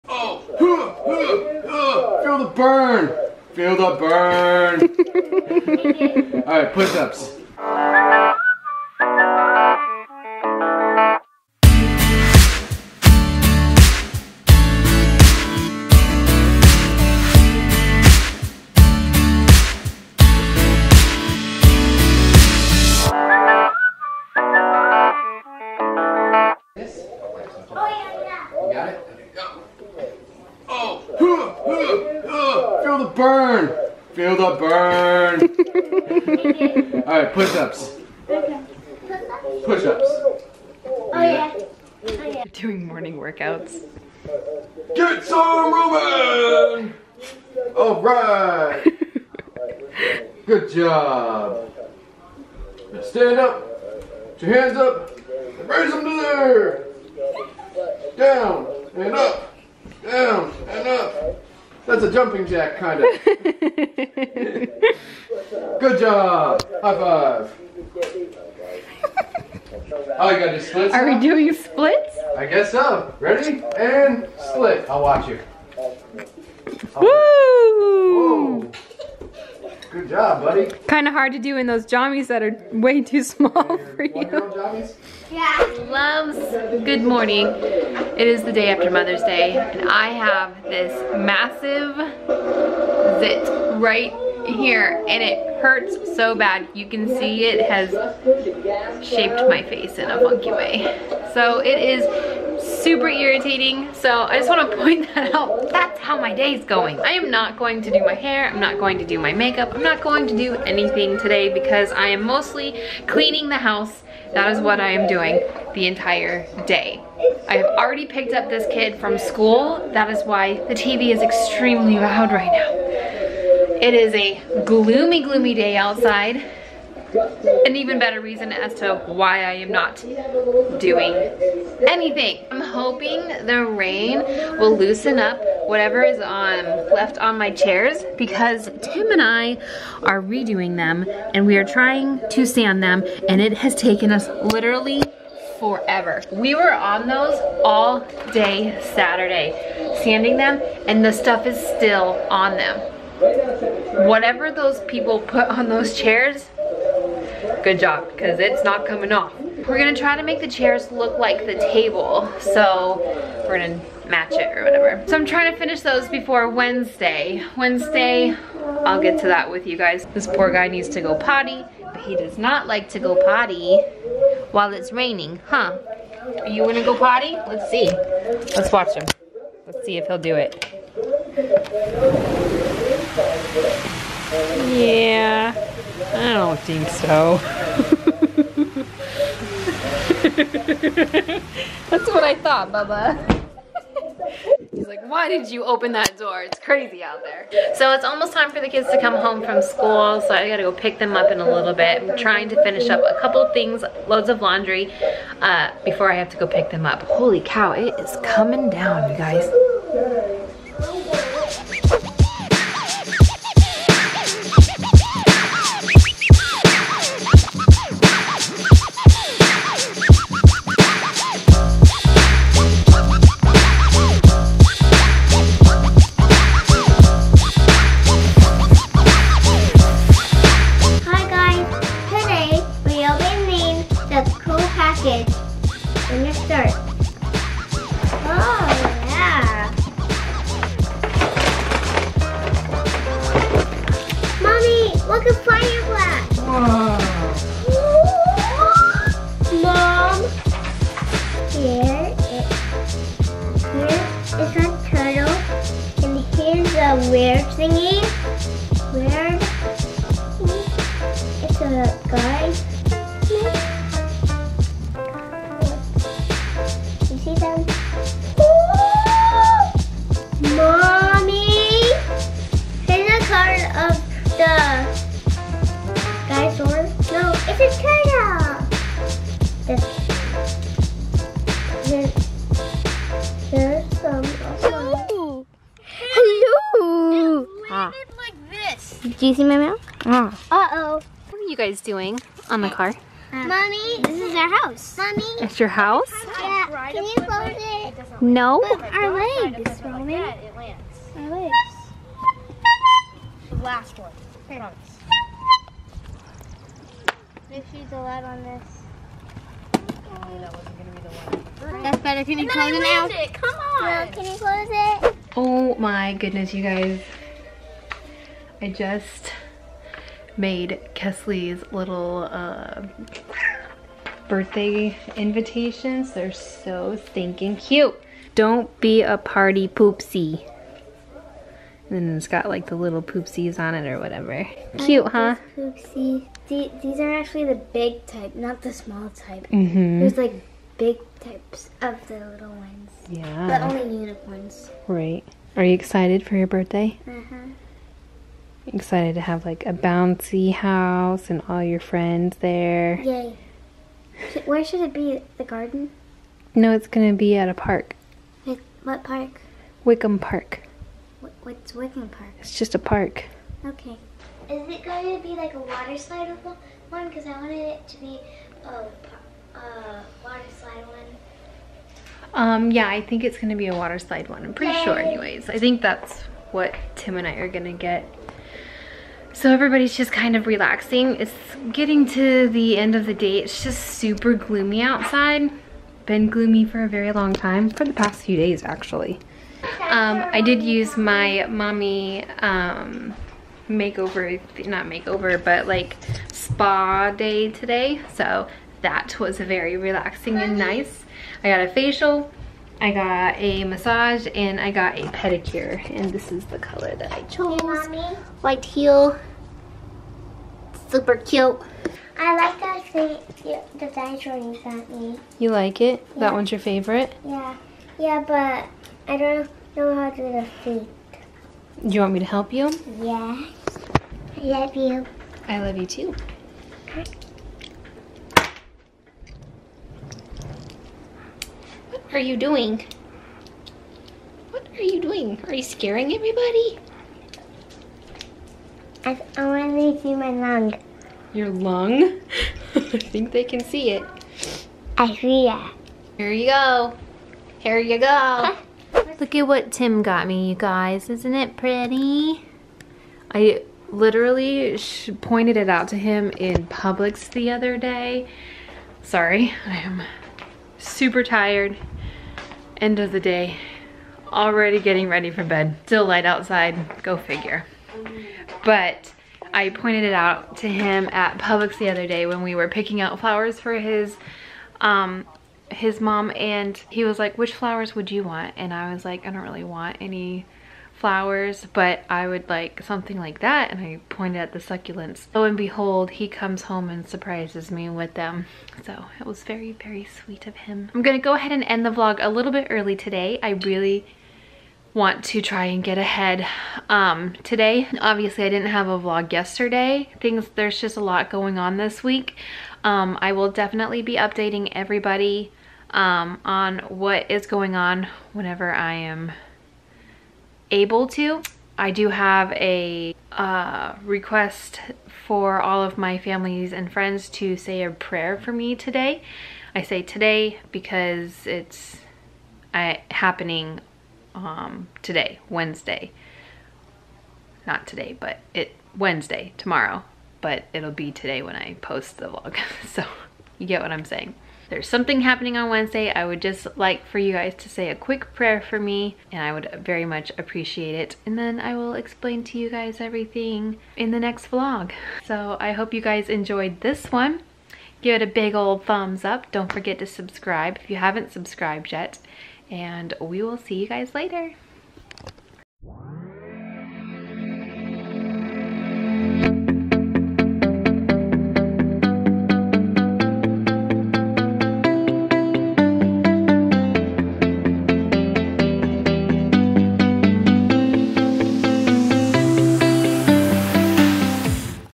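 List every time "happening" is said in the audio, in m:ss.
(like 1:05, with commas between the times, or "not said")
8:43, 8:55.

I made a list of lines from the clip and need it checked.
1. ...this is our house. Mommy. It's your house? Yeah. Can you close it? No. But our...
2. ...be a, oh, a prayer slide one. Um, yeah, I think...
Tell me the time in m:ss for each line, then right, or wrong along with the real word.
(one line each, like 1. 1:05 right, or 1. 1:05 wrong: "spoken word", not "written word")
1. 4:54 right
2. 6:07 wrong: "water", not "prayer".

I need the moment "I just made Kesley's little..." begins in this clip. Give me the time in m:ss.
5:18.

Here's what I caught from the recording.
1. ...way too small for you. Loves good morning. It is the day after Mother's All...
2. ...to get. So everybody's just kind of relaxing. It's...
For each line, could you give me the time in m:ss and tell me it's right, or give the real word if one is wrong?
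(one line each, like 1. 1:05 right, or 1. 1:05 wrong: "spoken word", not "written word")
1. 1:22 wrong: "Day", not "All"
2. 6:17 right.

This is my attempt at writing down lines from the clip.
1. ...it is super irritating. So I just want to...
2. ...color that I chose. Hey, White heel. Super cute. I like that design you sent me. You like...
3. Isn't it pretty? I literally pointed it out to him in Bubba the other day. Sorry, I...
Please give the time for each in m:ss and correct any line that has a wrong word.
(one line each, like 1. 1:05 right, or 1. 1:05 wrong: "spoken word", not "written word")
1. 1:41 right
2. 6:46 right
3. 7:31 wrong: "Publix", not "Bubba".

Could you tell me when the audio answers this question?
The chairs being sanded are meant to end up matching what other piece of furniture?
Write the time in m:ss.
2:41.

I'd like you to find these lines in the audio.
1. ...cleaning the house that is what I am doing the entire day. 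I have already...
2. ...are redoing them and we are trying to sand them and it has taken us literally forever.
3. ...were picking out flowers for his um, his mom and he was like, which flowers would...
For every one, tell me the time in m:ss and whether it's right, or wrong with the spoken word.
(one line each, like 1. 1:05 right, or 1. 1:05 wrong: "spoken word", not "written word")
1. 1:53 right
2. 2:20 right
3. 7:52 right.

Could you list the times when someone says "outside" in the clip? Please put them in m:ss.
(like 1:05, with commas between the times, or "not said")
2:05, 6:24, 7:46.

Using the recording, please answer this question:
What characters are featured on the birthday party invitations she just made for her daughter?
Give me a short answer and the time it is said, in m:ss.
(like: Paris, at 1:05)
Poopsies, at 5:33.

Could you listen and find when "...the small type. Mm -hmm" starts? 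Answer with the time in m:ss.
5:38.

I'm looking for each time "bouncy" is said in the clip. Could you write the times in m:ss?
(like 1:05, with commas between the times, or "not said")
5:49.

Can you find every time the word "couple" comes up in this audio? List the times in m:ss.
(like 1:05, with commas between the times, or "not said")
3:23.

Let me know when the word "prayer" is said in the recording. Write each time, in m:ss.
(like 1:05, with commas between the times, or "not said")
8:37, 8:58.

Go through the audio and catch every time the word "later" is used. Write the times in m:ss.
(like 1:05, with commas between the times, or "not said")
9:14.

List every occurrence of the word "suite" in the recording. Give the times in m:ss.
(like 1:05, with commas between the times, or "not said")
not said.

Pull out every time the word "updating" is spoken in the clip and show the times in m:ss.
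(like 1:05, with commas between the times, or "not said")
8:24.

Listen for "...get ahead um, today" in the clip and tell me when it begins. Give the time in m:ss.
8:15.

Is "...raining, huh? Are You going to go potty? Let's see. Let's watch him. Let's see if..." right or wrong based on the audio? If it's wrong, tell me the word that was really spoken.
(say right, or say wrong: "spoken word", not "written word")
right.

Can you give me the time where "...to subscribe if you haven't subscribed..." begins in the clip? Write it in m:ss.
9:09.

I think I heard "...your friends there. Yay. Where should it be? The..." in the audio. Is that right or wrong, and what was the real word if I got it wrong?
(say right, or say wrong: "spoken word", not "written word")
right.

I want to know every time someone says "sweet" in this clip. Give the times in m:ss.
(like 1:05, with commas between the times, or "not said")
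8:10.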